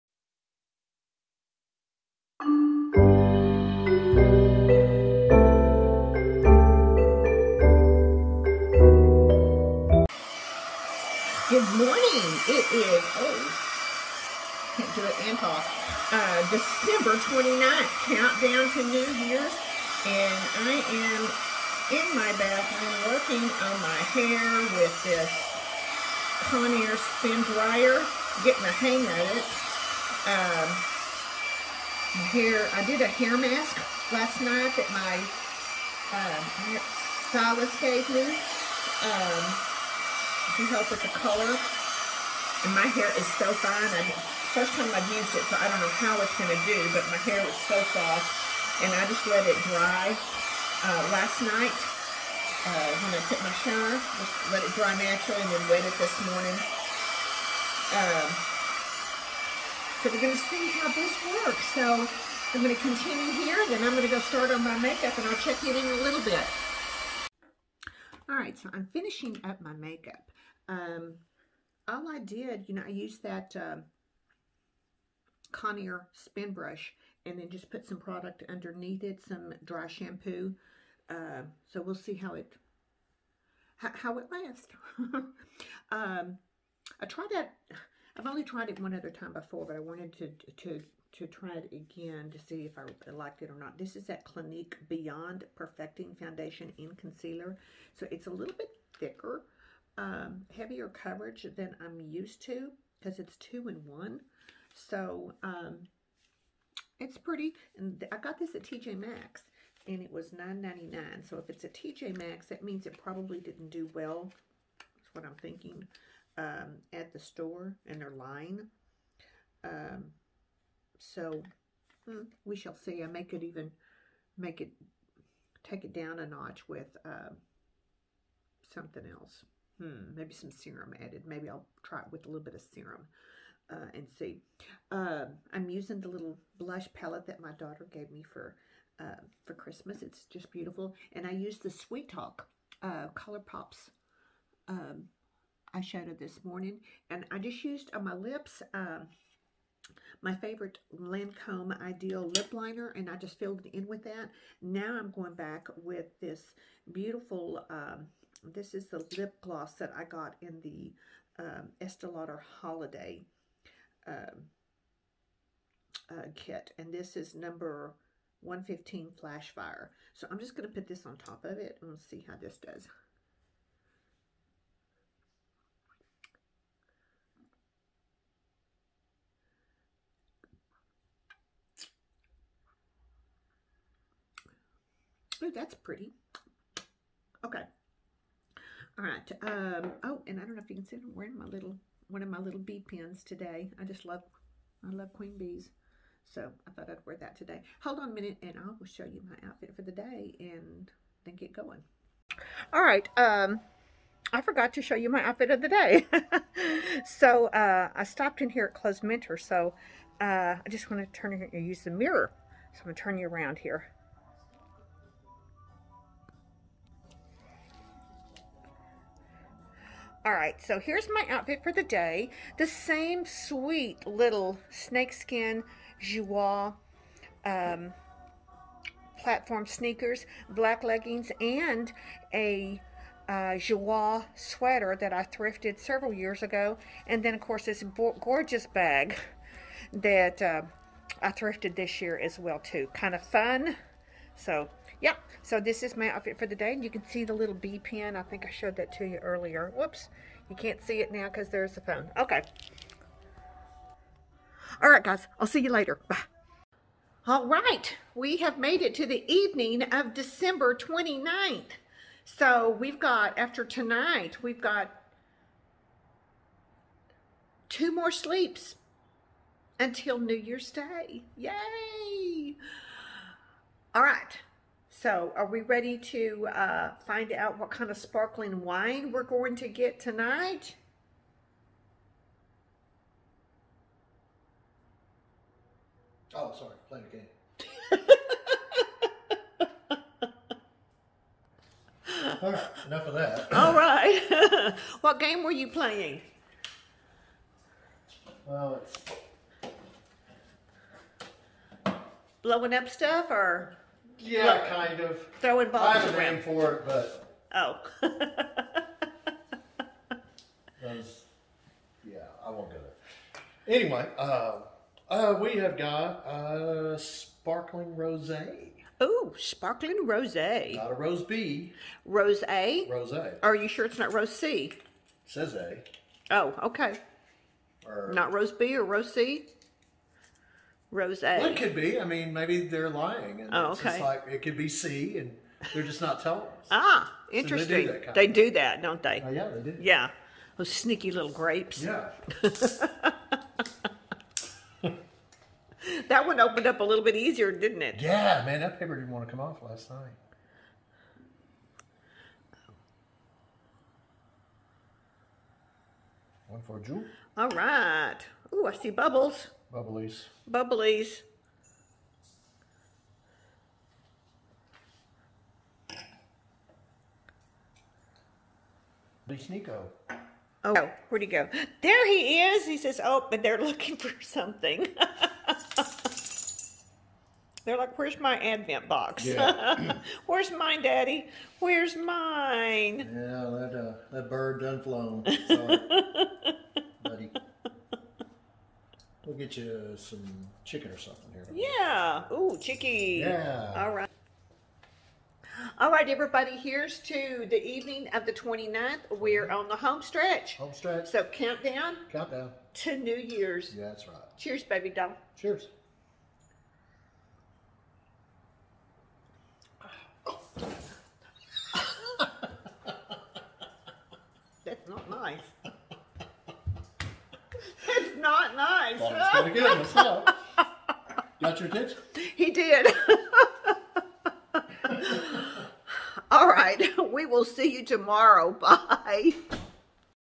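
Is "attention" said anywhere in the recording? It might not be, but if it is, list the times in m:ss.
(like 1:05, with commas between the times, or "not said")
7:01.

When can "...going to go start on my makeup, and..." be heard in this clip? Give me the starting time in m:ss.
1:03.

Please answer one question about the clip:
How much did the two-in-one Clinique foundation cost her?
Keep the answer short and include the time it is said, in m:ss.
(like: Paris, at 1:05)
$9.99, at 1:50.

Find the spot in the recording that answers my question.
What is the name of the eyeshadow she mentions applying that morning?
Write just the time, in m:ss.
2:21.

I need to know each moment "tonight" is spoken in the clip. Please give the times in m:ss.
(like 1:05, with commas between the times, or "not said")
4:23, 4:39.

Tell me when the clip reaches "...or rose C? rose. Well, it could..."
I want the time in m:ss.
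5:28.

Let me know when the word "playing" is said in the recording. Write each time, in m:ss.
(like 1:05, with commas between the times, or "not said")
4:46, 4:55.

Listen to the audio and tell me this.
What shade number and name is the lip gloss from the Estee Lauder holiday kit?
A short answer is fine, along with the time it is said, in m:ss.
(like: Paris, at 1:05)
115 Flash Fire, at 2:47.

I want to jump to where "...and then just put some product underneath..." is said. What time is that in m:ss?
1:17.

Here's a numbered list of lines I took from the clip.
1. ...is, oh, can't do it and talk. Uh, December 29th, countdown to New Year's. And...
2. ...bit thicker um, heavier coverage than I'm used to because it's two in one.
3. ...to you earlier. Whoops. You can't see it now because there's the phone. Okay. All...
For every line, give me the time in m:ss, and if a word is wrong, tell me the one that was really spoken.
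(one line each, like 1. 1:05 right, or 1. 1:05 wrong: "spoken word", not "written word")
1. 0:12 right
2. 1:38 right
3. 4:08 right.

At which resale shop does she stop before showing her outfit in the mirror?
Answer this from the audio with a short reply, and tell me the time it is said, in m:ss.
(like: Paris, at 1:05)
Clothes Mentor, at 3:28.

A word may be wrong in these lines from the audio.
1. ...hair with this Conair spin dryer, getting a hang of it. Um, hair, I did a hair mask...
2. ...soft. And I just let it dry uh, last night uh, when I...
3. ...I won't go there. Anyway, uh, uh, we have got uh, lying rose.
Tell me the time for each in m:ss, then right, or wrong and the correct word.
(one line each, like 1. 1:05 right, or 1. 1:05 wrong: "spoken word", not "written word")
1. 0:24 right
2. 0:47 right
3. 5:12 wrong: "sparkling", not "lying".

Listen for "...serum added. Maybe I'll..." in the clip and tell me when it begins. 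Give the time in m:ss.
2:10.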